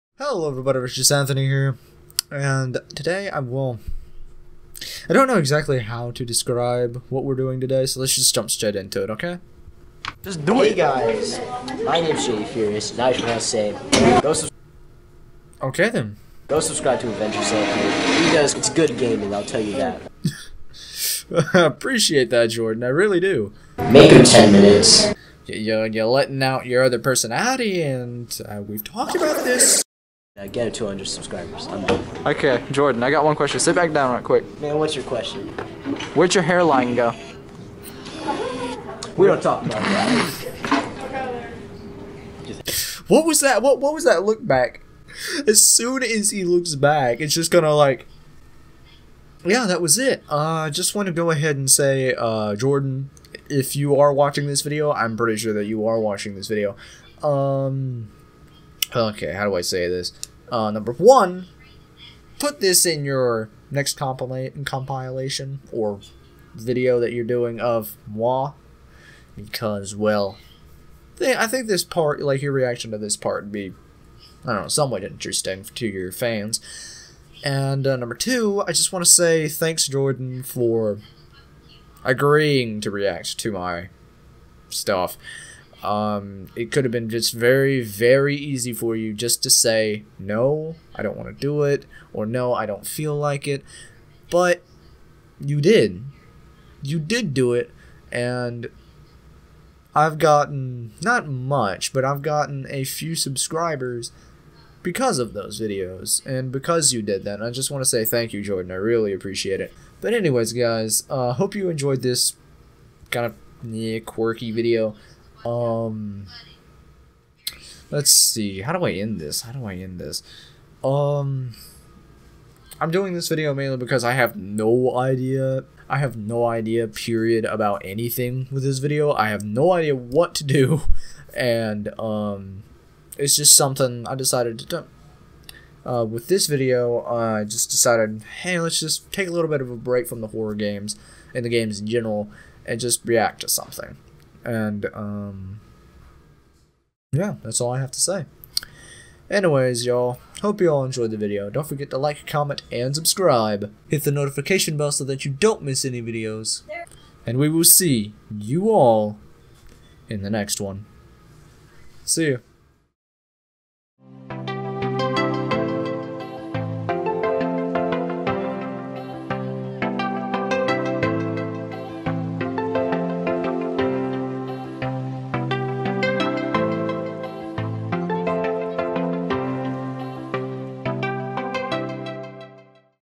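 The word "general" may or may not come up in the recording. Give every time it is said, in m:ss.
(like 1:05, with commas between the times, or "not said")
2:21.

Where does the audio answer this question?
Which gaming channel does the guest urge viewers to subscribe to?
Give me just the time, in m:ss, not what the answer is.
0:17.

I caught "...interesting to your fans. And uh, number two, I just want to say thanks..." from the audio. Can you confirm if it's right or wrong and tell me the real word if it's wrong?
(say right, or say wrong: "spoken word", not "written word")
right.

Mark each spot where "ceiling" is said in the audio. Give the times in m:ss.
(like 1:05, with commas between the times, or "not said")
not said.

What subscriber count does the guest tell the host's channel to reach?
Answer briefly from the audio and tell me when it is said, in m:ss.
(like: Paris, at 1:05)
200, at 0:30.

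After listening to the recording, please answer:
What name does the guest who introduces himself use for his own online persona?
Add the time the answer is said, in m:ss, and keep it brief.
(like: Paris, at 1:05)
Jay Furious, at 0:12.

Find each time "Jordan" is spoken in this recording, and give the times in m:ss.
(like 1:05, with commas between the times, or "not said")
0:22, 0:32, 0:52, 1:19, 1:48.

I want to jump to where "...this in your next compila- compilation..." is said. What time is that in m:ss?
1:02.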